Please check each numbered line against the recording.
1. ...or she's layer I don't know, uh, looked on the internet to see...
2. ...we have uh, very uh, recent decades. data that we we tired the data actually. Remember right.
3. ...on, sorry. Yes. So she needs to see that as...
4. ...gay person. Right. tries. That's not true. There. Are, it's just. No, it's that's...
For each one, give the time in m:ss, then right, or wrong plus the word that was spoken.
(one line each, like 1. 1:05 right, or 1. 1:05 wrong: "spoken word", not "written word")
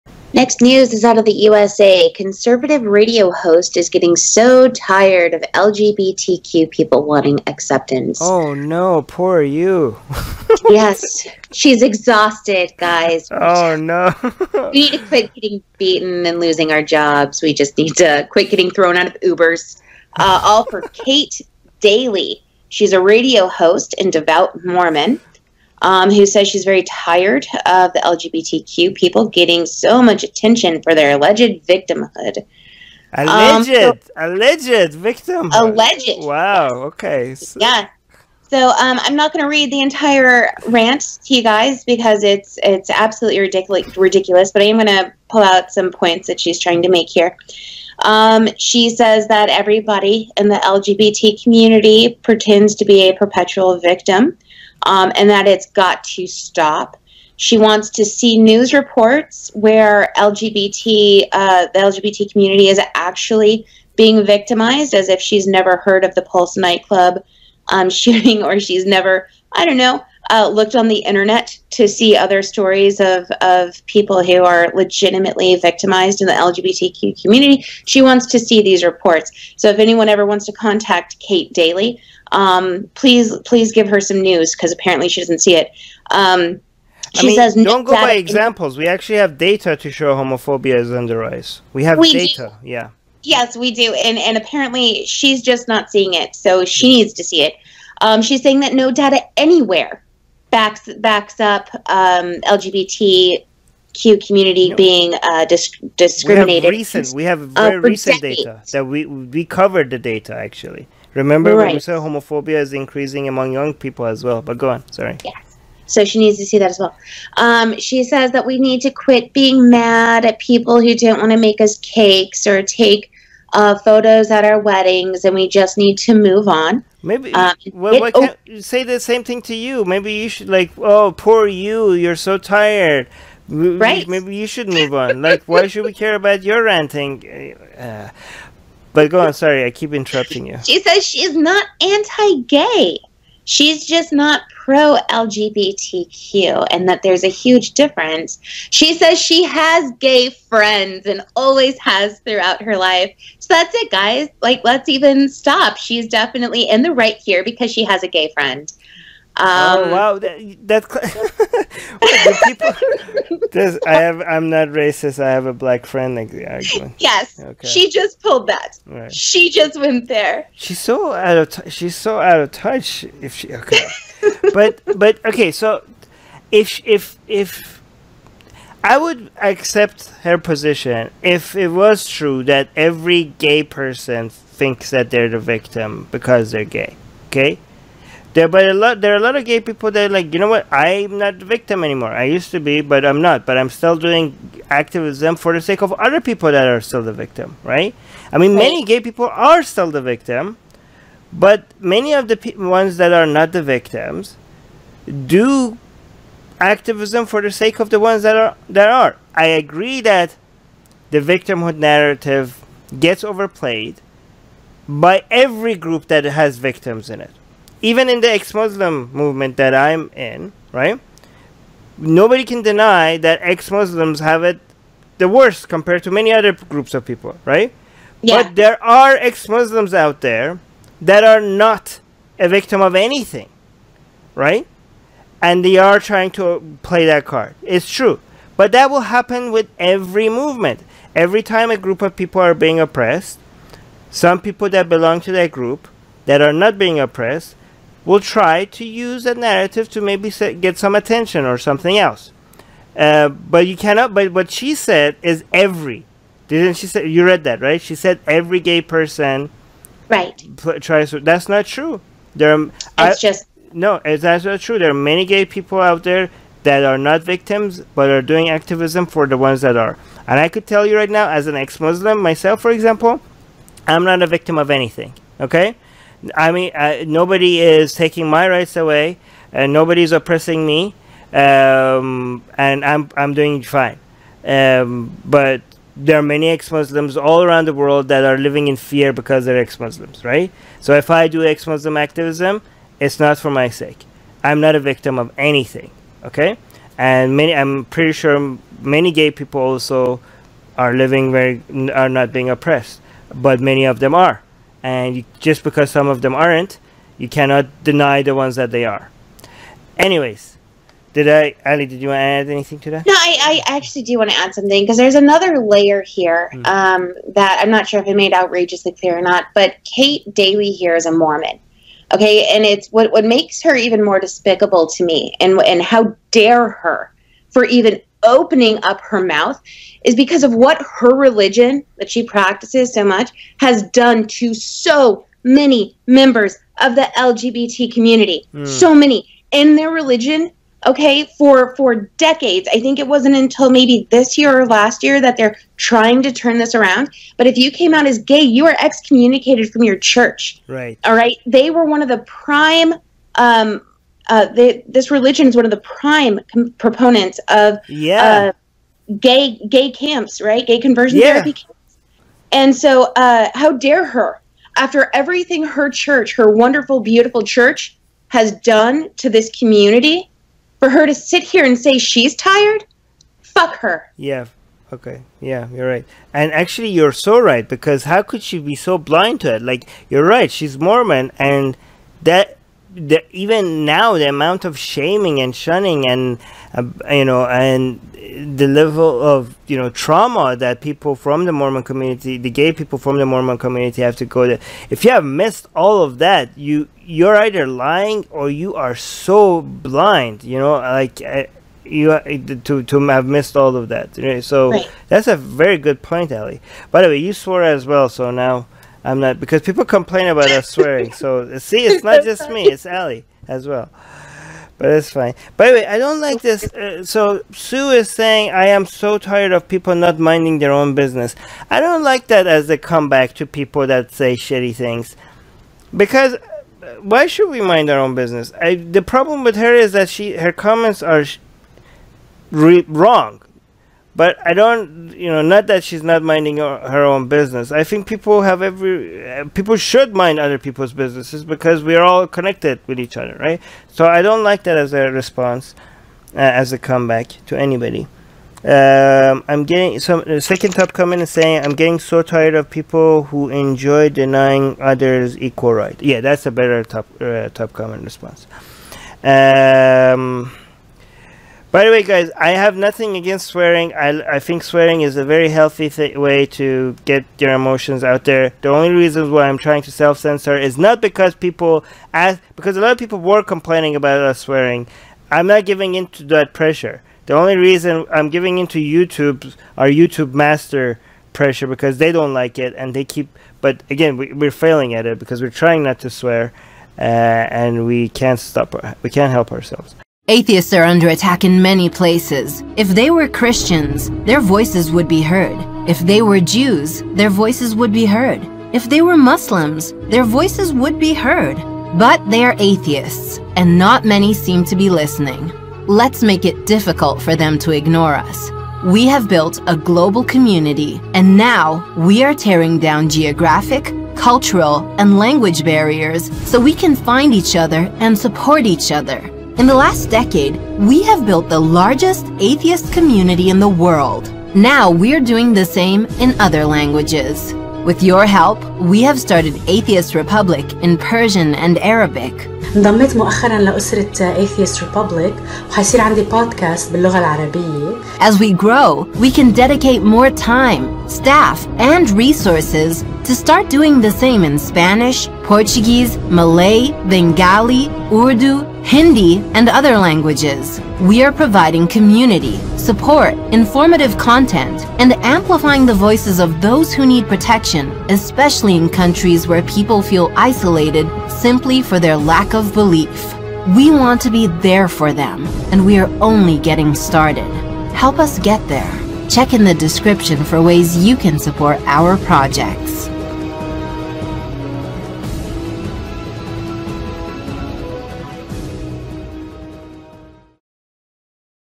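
1. 1:08 wrong: "never", not "layer"
2. 1:47 wrong: "covered", not "tired"
3. 1:54 right
4. 4:18 right.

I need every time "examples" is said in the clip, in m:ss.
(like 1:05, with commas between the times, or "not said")
1:28, 4:32.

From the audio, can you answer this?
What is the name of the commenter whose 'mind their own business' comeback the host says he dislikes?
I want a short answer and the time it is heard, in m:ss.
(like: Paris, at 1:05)
Sue, at 6:57.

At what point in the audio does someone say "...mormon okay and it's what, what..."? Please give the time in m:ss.
5:21.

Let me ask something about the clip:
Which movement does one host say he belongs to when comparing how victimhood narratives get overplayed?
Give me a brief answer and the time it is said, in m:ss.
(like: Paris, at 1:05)
ex-Muslim movement, at 3:38.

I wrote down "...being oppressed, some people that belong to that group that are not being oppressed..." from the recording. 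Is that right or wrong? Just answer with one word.
right.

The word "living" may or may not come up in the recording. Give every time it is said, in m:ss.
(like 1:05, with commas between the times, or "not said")
4:48, 5:00.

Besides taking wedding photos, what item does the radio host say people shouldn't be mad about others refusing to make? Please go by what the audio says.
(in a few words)
Cakes.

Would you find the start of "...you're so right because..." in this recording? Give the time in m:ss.
6:16.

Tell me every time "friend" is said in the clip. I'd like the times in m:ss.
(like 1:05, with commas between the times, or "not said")
2:30, 2:38, 2:45.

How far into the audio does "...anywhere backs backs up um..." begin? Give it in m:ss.
1:39.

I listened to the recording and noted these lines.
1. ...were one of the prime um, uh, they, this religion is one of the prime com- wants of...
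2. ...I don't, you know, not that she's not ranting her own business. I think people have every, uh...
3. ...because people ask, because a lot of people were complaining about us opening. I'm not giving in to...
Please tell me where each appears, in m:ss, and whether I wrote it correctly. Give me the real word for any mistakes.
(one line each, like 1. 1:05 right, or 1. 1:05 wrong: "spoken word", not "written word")
1. 5:51 wrong: "proponents", not "wants"
2. 7:14 wrong: "minding", not "ranting"
3. 7:51 wrong: "swearing", not "opening".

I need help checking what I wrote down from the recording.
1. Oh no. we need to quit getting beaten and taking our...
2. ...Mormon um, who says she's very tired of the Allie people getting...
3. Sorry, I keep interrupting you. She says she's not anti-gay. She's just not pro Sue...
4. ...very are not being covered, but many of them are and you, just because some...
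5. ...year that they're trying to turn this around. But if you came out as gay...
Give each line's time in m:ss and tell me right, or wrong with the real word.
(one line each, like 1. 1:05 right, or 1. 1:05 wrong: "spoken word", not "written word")
1. 0:13 wrong: "losing", not "taking"
2. 0:24 wrong: "LGBTQ", not "Allie"
3. 2:19 wrong: "LGBTQ", not "Sue"
4. 5:01 wrong: "oppressed", not "covered"
5. 5:45 right.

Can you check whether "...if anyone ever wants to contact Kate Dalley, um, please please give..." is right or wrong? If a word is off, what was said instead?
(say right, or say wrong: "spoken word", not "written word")
right.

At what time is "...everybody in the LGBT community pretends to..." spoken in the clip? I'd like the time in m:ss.
0:49.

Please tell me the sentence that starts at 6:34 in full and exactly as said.
If you have missed all of that, you you're either lying or you are so blind.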